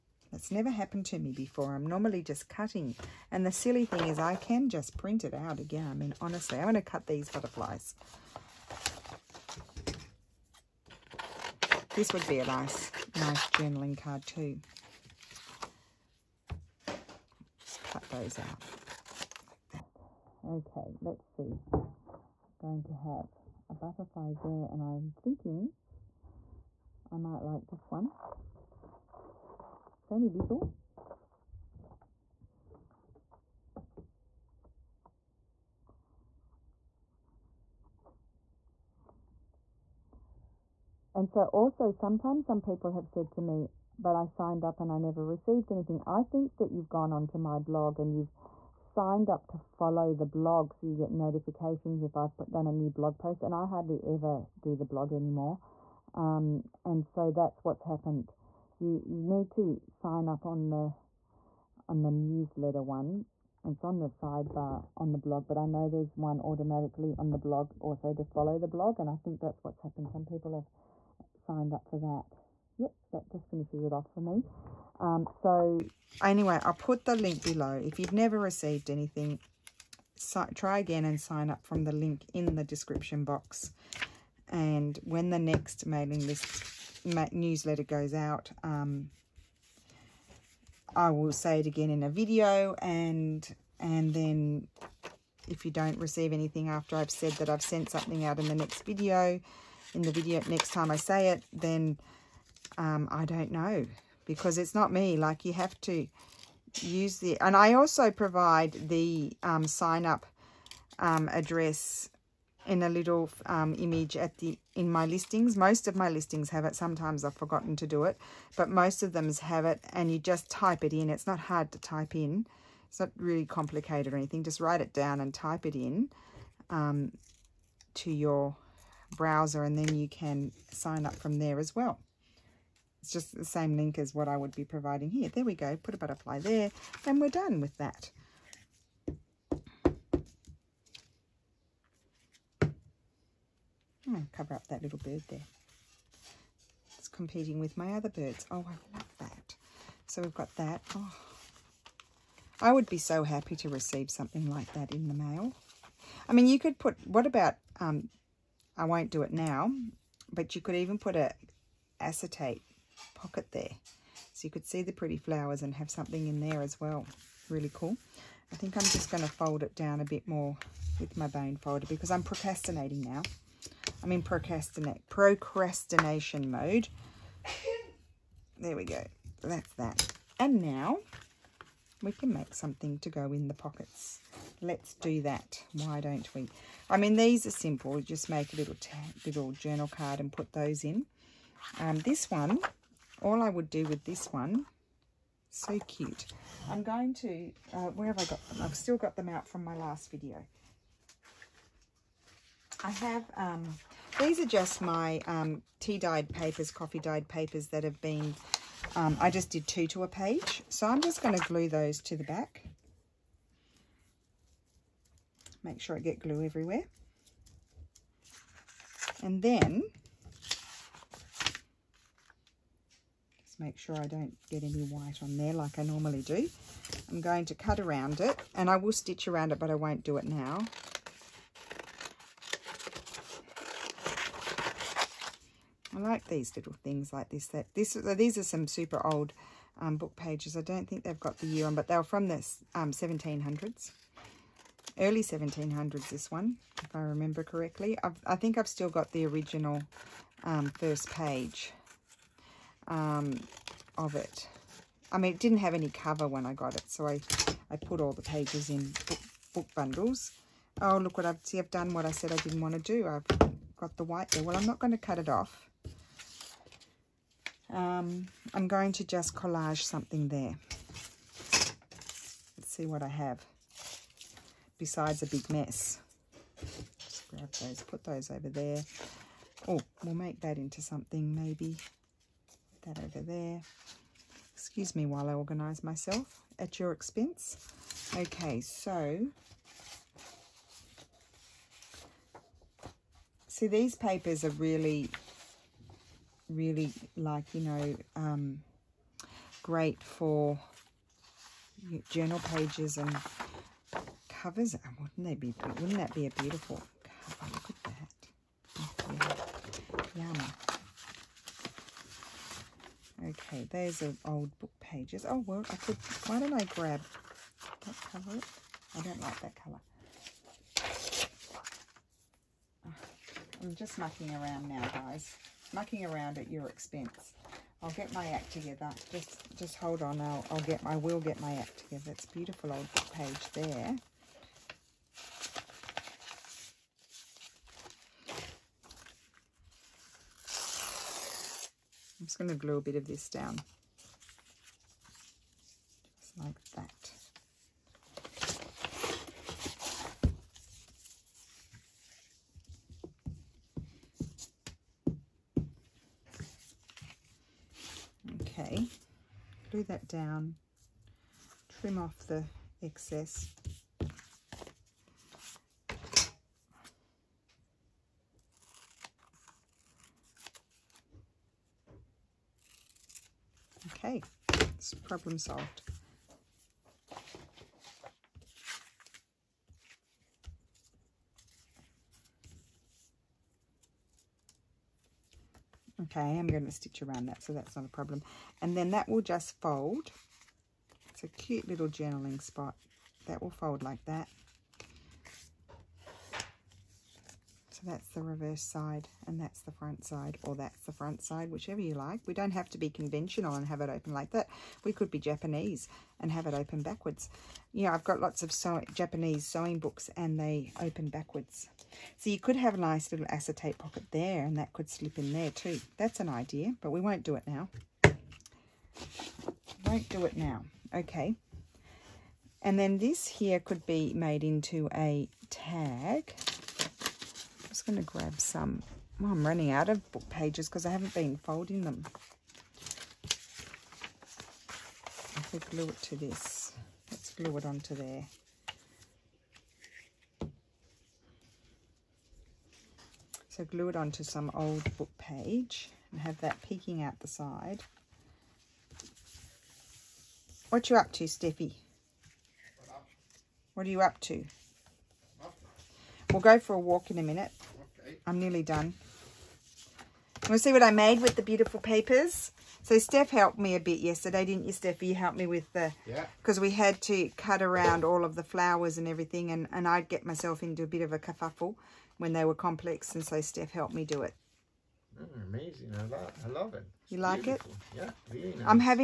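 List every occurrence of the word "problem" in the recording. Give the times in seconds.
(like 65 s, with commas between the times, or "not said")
374 s, 387 s.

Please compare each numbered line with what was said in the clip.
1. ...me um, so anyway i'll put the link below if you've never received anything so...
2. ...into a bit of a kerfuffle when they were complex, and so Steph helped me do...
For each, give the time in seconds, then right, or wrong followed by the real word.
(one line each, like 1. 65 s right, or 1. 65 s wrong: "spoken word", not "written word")
1. 74 s right
2. 470 s right.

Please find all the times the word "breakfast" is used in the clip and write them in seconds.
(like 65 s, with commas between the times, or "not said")
not said.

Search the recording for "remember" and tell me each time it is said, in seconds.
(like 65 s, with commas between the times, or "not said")
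247 s.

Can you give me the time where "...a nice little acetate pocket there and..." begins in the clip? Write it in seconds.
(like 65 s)
412 s.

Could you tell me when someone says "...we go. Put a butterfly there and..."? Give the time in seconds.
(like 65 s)
135 s.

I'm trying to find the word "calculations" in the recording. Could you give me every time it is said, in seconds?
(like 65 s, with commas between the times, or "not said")
not said.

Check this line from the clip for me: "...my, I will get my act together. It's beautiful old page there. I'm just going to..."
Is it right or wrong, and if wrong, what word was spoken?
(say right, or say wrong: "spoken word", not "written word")
right.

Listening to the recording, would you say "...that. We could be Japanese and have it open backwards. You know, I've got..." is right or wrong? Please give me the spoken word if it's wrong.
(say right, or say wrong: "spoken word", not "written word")
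right.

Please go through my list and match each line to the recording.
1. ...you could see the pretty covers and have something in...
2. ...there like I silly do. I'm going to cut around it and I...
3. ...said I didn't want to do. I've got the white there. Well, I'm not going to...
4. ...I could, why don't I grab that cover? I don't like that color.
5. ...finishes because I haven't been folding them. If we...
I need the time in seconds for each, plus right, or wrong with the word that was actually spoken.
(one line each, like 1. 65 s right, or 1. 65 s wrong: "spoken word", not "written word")
1. 164 s wrong: "flowers", not "covers"
2. 225 s wrong: "normally", not "silly"
3. 262 s right
4. 315 s right
5. 430 s wrong: "pages", not "finishes".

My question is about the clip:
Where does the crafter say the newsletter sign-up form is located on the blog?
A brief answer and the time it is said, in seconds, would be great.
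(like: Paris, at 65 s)
on the sidebar, at 63 s.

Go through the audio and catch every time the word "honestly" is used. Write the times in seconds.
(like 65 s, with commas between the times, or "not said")
6 s.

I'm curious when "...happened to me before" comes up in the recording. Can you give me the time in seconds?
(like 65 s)
0 s.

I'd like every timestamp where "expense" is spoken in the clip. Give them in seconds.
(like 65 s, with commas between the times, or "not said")
286 s, 326 s.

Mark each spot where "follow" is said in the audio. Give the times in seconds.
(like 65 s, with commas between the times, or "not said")
49 s, 68 s.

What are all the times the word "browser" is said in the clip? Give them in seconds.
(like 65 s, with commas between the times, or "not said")
129 s.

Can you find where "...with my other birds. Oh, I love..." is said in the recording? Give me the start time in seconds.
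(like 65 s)
147 s.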